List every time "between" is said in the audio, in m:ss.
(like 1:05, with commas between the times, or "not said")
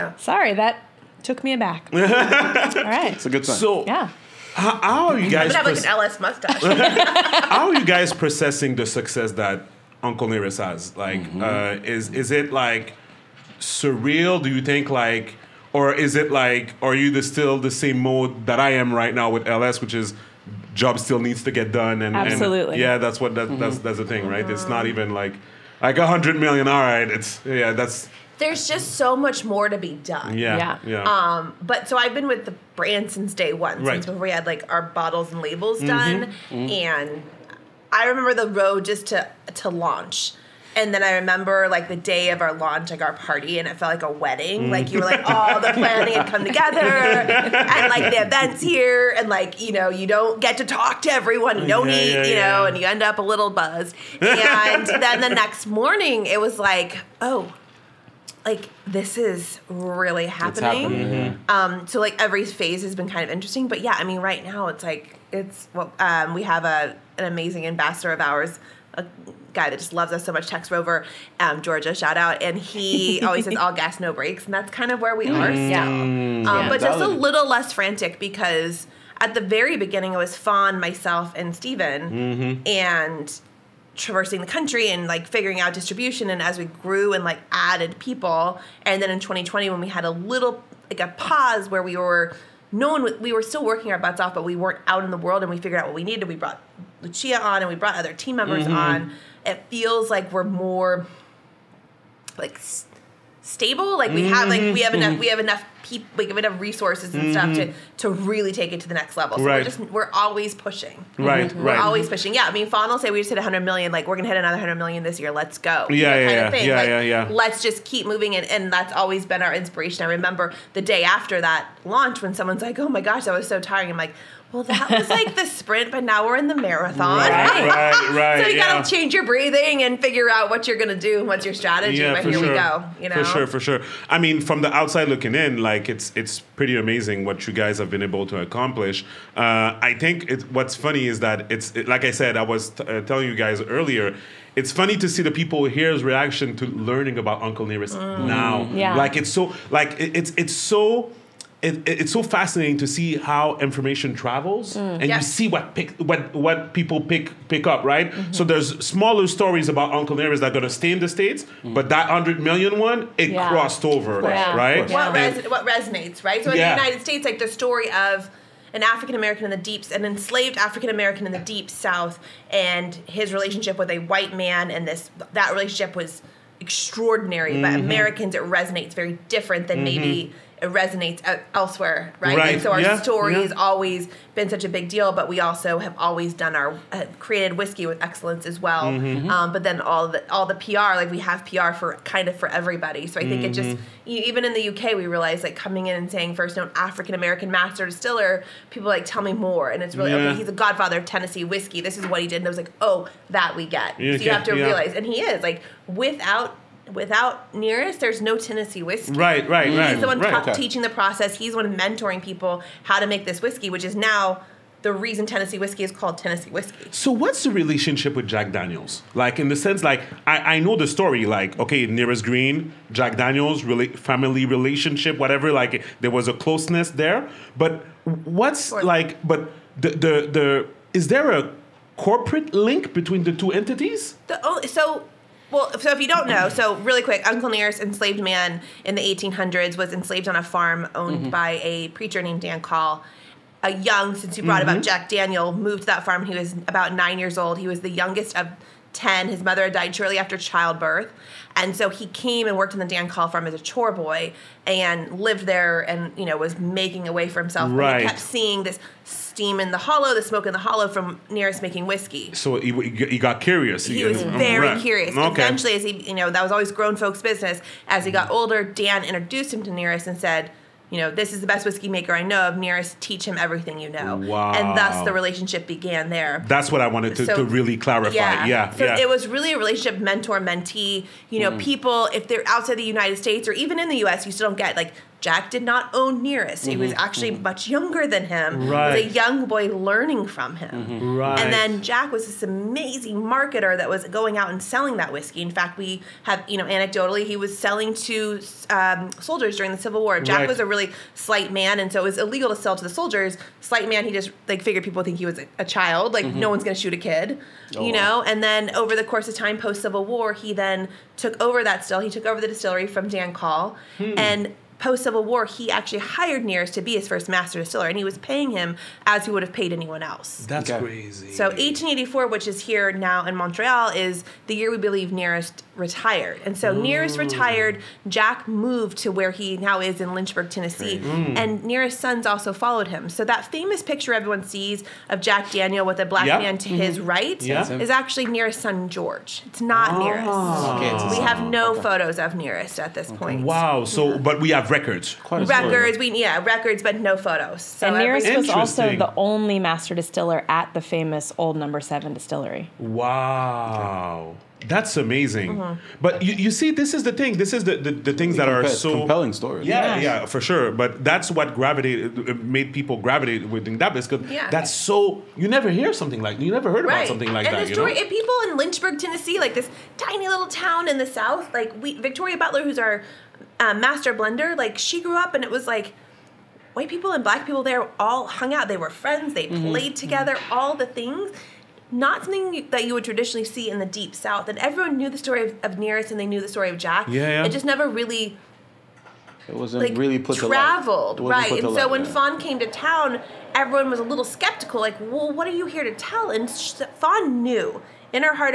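3:52.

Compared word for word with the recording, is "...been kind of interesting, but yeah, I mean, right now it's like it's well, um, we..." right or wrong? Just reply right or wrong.
right.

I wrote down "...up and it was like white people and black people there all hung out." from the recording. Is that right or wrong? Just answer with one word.
right.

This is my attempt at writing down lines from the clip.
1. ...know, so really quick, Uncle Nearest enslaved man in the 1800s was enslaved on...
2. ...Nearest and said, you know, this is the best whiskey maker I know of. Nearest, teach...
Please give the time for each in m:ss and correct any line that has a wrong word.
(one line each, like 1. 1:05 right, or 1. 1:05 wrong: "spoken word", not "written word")
1. 3:56 right
2. 4:29 right.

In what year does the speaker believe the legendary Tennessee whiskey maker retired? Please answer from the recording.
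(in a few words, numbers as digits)
1884.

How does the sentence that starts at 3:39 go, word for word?
Like in the sense, like I, I know the story, like okay, Nearest Green, Jack Daniels, really family relationship, whatever.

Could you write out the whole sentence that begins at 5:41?
photos of Nearest at this okay.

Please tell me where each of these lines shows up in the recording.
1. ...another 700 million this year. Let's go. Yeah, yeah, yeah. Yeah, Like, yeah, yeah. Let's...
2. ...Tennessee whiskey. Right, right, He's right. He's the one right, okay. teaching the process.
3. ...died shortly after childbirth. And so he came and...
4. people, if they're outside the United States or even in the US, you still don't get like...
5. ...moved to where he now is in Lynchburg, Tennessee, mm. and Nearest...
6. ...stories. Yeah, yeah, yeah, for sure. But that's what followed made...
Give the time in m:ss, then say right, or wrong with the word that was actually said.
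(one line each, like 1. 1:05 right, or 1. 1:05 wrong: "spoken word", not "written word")
1. 1:54 wrong: "100", not "700"
2. 3:28 right
3. 4:09 right
4. 4:41 right
5. 5:28 right
6. 5:59 wrong: "gravitated", not "followed".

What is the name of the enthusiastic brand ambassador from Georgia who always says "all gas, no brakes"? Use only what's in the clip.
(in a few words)
Tex Rover.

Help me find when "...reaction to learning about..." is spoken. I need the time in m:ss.
2:26.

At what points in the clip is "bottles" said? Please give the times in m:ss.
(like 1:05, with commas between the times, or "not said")
0:34.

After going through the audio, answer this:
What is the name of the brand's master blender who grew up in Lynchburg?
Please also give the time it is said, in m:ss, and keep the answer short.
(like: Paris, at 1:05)
Victoria Butler, at 6:11.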